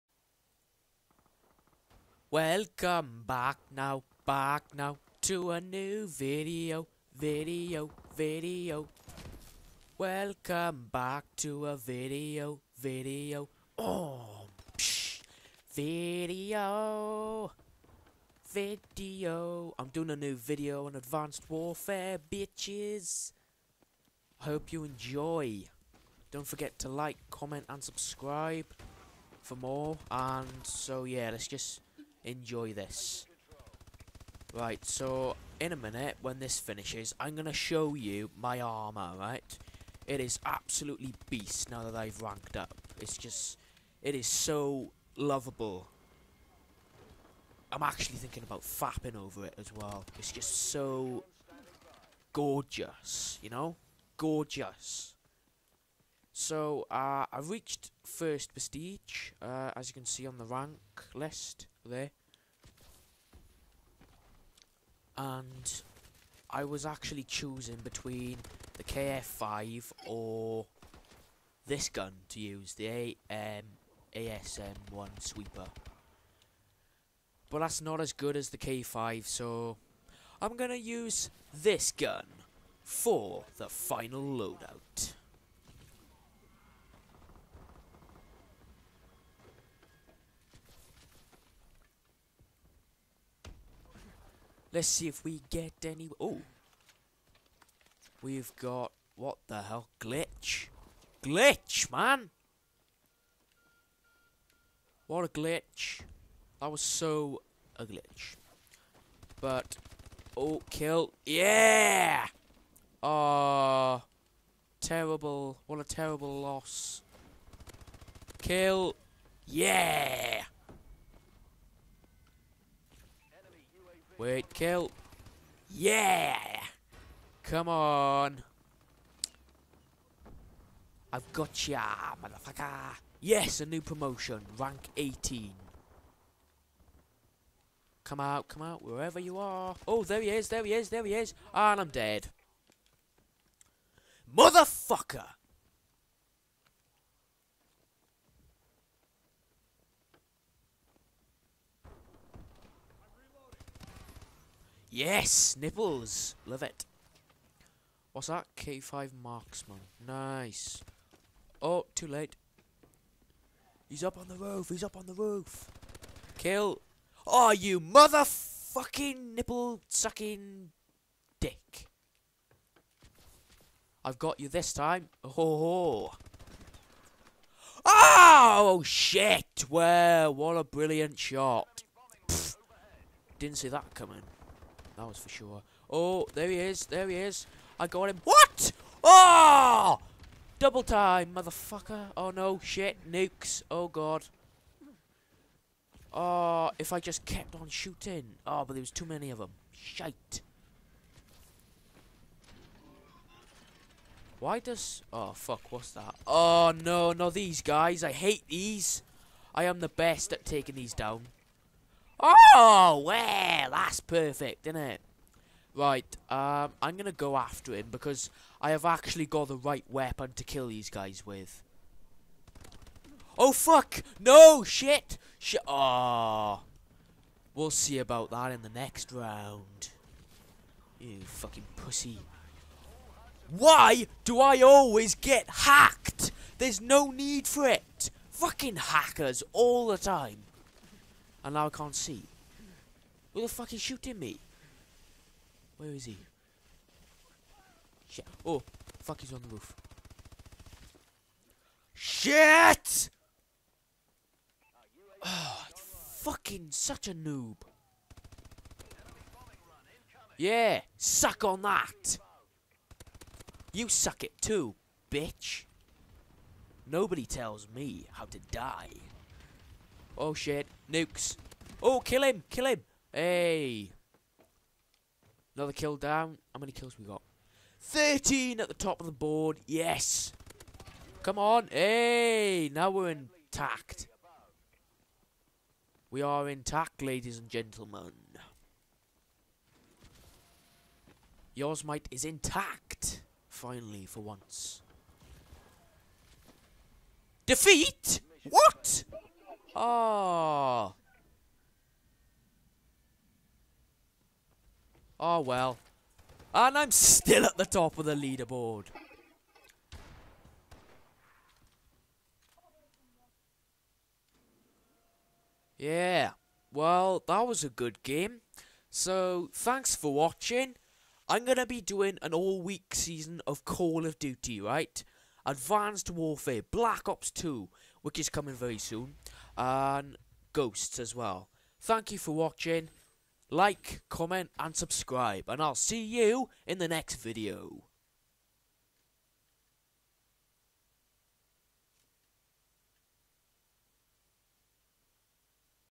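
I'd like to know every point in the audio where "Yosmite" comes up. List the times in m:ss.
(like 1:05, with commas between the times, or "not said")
4:51.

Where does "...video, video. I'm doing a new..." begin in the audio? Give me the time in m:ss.
0:15.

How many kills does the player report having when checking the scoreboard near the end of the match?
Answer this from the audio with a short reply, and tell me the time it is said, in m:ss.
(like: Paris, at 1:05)
13, at 4:37.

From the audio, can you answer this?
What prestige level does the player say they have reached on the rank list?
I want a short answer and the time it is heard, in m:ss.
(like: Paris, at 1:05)
First prestige, at 0:58.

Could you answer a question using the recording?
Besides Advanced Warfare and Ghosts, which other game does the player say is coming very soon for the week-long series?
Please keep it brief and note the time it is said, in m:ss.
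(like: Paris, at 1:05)
Black Ops 2, at 5:26.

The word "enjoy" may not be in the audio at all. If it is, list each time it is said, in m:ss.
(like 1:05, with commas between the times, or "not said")
0:24, 0:32.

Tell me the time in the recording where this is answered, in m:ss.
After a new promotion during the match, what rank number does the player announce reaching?
2:14.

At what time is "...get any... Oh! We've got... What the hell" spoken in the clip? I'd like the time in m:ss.
1:35.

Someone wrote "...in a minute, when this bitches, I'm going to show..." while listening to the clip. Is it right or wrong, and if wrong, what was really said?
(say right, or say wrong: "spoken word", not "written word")
wrong: "finishes", not "bitches".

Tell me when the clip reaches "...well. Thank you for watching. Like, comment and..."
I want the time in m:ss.
5:31.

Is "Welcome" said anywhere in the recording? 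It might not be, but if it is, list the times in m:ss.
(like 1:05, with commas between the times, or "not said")
0:02, 0:09.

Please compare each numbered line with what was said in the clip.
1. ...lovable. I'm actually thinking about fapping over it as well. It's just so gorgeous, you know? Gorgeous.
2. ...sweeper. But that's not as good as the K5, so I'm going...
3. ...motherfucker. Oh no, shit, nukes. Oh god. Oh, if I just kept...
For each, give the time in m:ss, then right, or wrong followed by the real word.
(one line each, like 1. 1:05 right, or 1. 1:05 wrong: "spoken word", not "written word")
1. 0:45 right
2. 1:15 right
3. 3:11 right.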